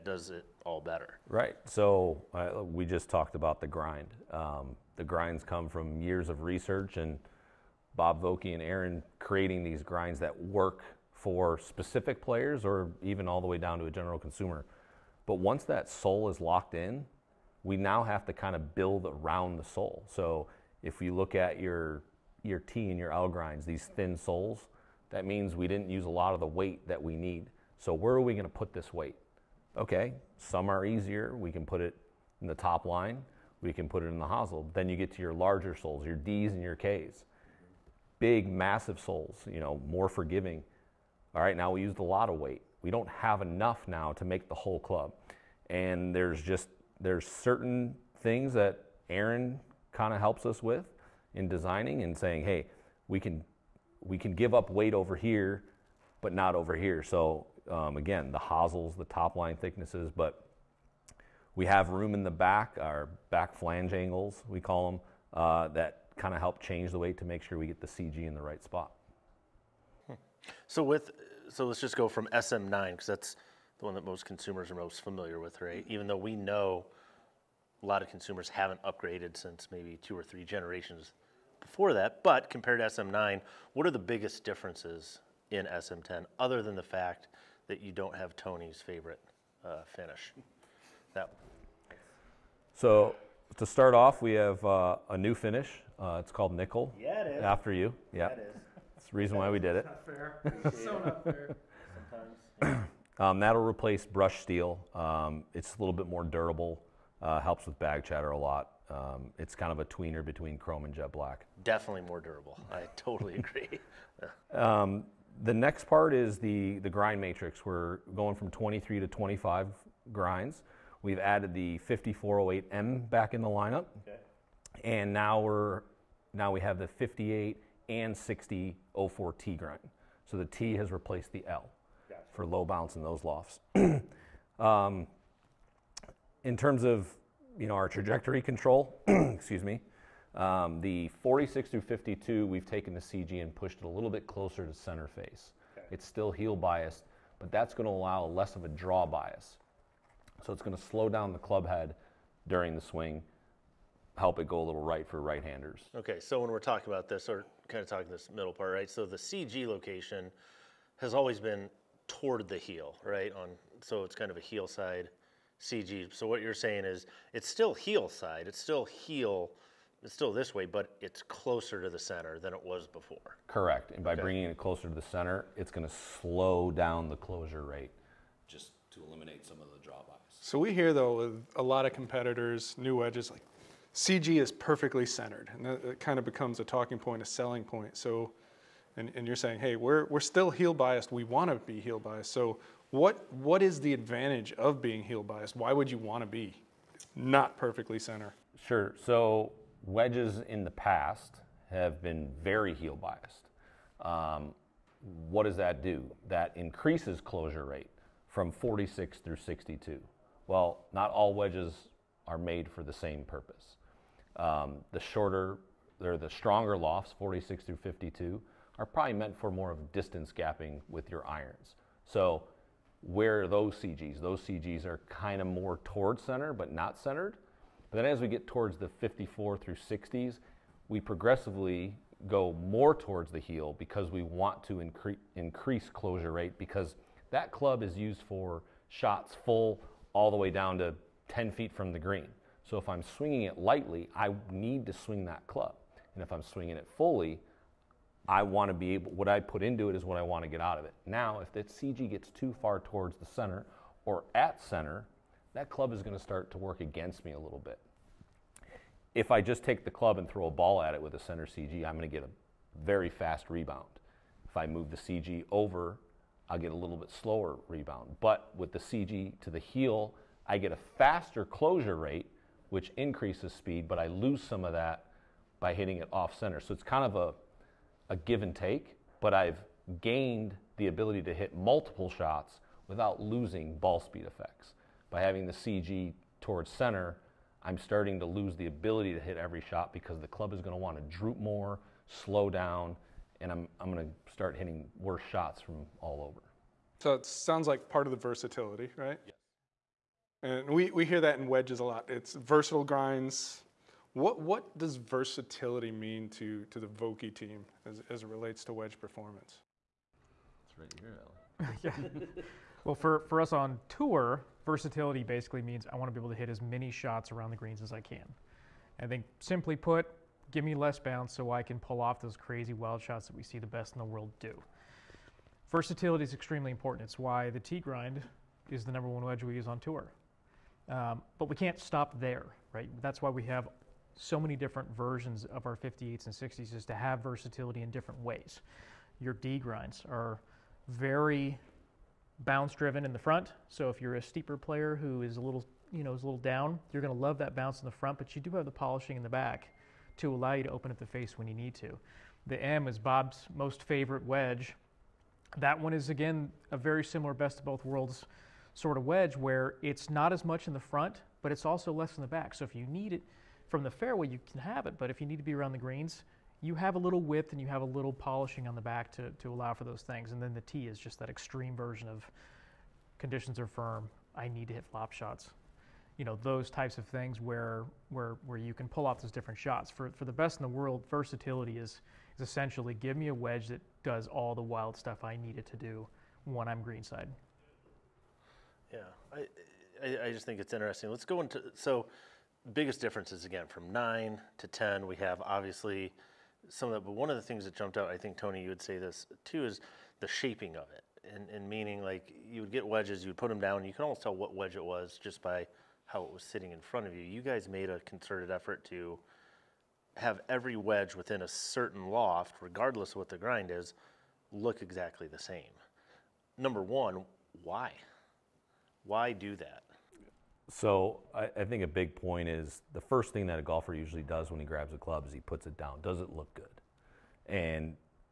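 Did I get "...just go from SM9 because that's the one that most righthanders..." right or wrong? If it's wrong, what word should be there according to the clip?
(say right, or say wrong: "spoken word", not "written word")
wrong: "consumers", not "righthanders".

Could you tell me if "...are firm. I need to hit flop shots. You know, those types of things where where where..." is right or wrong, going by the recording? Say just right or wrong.
right.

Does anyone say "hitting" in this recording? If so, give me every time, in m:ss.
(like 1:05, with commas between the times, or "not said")
4:35, 4:54.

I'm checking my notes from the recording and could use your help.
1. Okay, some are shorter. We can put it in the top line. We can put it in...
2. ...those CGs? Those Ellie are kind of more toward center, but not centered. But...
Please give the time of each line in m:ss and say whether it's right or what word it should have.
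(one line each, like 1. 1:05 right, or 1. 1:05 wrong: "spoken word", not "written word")
1. 0:29 wrong: "easier", not "shorter"
2. 3:43 wrong: "CGs", not "Ellie".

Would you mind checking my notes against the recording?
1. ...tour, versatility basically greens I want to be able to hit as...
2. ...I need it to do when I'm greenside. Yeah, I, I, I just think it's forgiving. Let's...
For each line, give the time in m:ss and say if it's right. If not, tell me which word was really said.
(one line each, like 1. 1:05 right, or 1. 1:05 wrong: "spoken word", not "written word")
1. 5:13 wrong: "means", not "greens"
2. 6:25 wrong: "interesting", not "forgiving".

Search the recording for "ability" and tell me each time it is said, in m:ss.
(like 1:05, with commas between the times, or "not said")
4:40, 4:48.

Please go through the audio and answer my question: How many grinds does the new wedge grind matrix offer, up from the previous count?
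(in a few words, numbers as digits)
25.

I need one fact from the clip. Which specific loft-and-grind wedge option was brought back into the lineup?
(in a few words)
5408M.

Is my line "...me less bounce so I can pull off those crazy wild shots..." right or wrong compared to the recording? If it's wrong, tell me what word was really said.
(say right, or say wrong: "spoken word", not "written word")
right.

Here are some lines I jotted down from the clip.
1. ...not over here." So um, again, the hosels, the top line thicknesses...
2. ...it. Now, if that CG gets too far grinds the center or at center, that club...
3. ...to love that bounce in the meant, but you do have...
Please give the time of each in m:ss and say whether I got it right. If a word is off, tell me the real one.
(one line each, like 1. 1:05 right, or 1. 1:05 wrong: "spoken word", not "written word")
1. 0:56 right
2. 4:10 wrong: "towards", not "grinds"
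3. 5:47 wrong: "front", not "meant".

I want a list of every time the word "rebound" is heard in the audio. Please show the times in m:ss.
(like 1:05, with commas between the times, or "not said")
4:23, 4:27.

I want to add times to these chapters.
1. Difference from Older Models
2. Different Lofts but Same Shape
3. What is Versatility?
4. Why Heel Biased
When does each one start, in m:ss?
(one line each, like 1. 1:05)
1. 1:38
2. 6:59
3. 5:11
4. 3:17.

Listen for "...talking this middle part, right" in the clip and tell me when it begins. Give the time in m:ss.
2:37.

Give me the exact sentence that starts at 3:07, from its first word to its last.
So, and, and you're saying, hey, we're, we're still heel biased.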